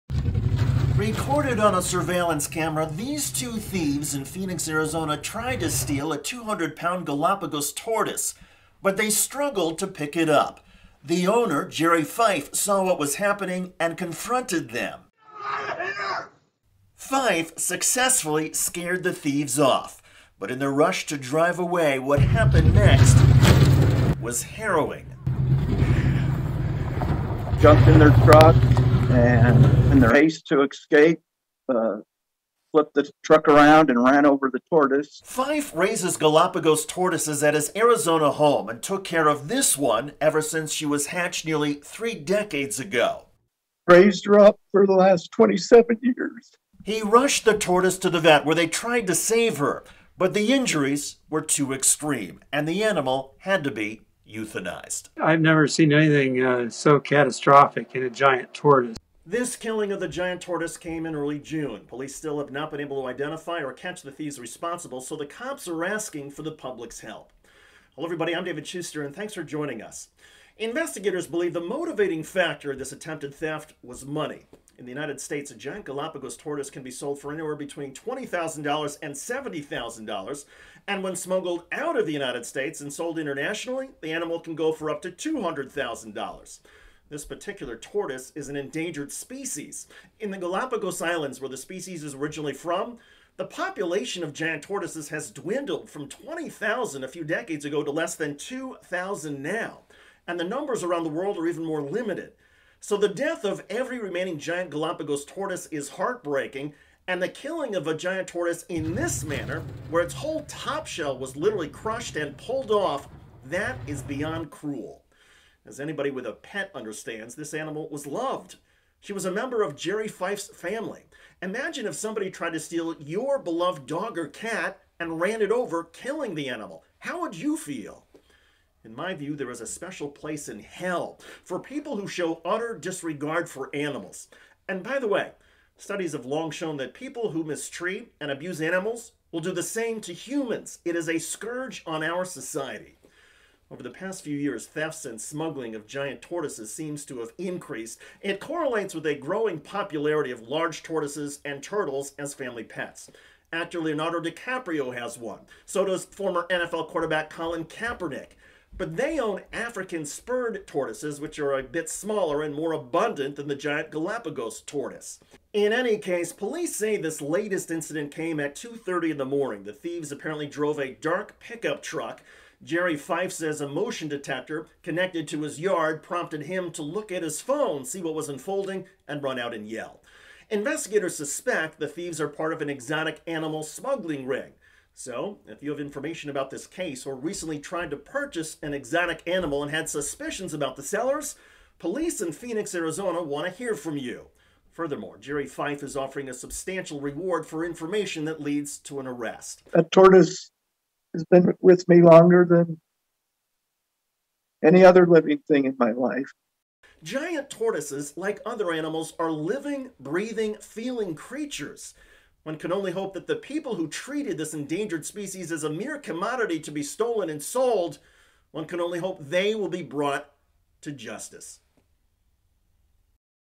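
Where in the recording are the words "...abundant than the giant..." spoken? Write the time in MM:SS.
02:42.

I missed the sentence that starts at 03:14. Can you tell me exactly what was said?
Furthermore, Jerry Fife is offering a substantial reward for information that leads to an arrest.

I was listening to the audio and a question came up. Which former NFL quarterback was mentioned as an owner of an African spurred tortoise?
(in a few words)
Colin Kaepernick.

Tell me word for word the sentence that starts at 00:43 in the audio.
Raised her up for the last 27 years.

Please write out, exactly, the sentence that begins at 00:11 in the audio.
The owner, Jerry Fife, saw what was happening and confronted them.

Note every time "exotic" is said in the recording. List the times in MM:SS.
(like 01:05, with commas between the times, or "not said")
03:02, 03:08.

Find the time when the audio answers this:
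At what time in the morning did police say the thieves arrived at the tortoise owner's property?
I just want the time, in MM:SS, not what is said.
02:48.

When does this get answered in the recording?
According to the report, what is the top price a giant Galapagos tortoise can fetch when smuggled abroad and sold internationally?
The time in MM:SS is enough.
01:25.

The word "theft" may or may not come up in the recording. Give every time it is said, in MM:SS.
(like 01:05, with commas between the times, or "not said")
01:13, 02:24.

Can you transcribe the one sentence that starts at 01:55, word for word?
As anybody with a pet understands, this animal was loved.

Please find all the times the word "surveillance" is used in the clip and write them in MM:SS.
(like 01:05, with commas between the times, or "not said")
00:01.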